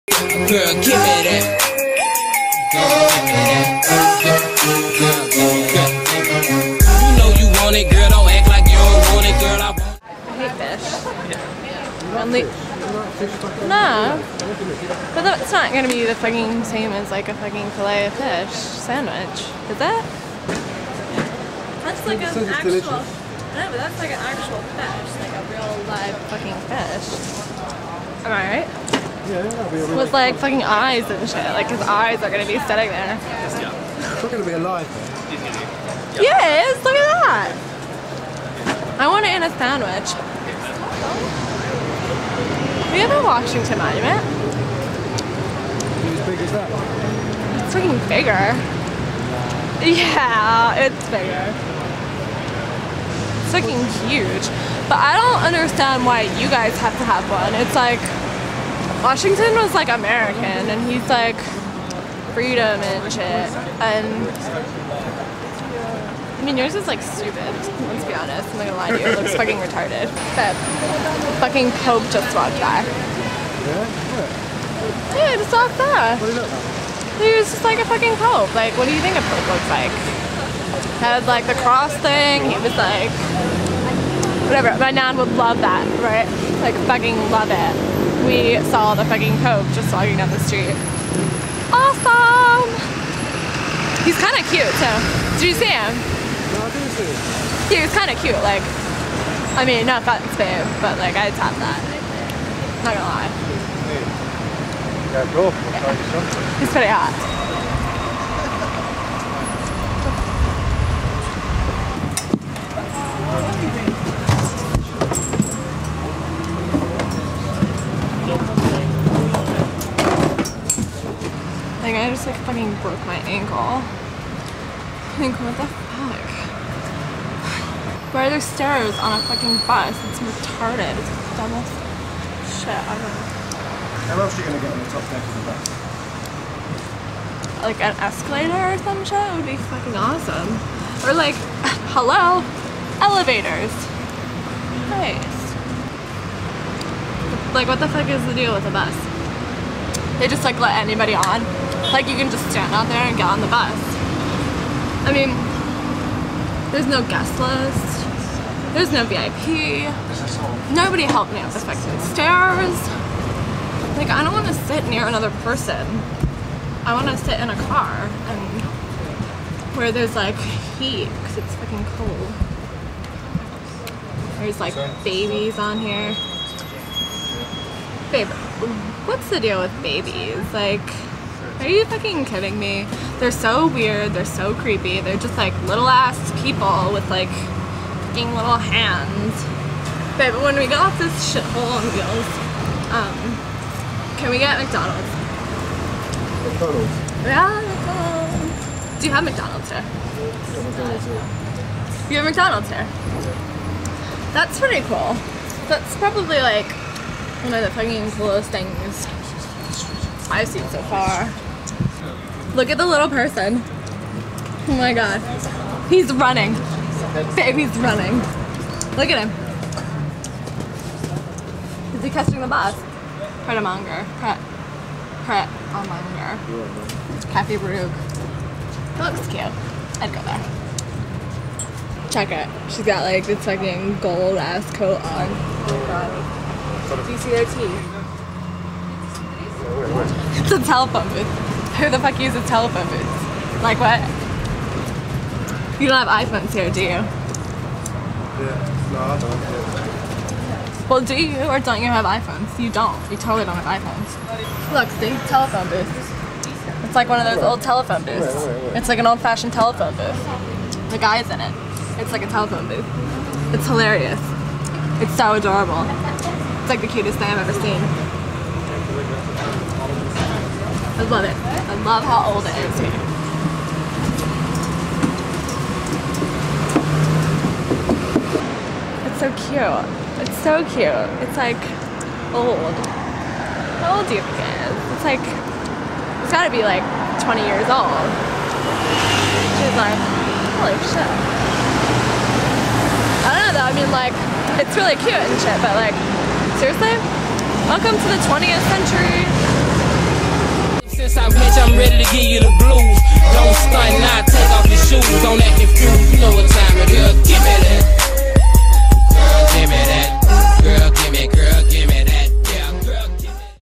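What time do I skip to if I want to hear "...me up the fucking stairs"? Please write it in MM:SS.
02:41.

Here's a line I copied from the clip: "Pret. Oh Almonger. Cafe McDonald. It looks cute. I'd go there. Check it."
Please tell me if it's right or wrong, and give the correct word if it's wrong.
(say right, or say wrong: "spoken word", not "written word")
wrong: "Baruch", not "McDonald".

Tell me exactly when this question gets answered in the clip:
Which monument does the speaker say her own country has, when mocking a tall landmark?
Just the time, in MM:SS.
00:43.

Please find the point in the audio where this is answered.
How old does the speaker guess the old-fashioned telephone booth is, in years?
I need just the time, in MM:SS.
04:47.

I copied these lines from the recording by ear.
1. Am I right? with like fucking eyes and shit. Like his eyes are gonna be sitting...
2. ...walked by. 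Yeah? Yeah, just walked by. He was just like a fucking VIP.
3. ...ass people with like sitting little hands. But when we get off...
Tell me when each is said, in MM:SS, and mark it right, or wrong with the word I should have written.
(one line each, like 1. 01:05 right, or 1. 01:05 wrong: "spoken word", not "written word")
1. 00:28 right
2. 01:12 wrong: "Pope", not "VIP"
3. 03:05 wrong: "fucking", not "sitting".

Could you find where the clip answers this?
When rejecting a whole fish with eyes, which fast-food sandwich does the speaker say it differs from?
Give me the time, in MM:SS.
00:17.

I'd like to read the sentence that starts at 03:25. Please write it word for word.
That's probably like one of the fucking coolest things I've seen so far.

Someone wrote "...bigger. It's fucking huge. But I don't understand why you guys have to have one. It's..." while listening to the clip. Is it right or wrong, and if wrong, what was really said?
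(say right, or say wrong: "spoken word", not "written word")
right.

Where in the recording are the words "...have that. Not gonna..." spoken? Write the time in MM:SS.
01:41.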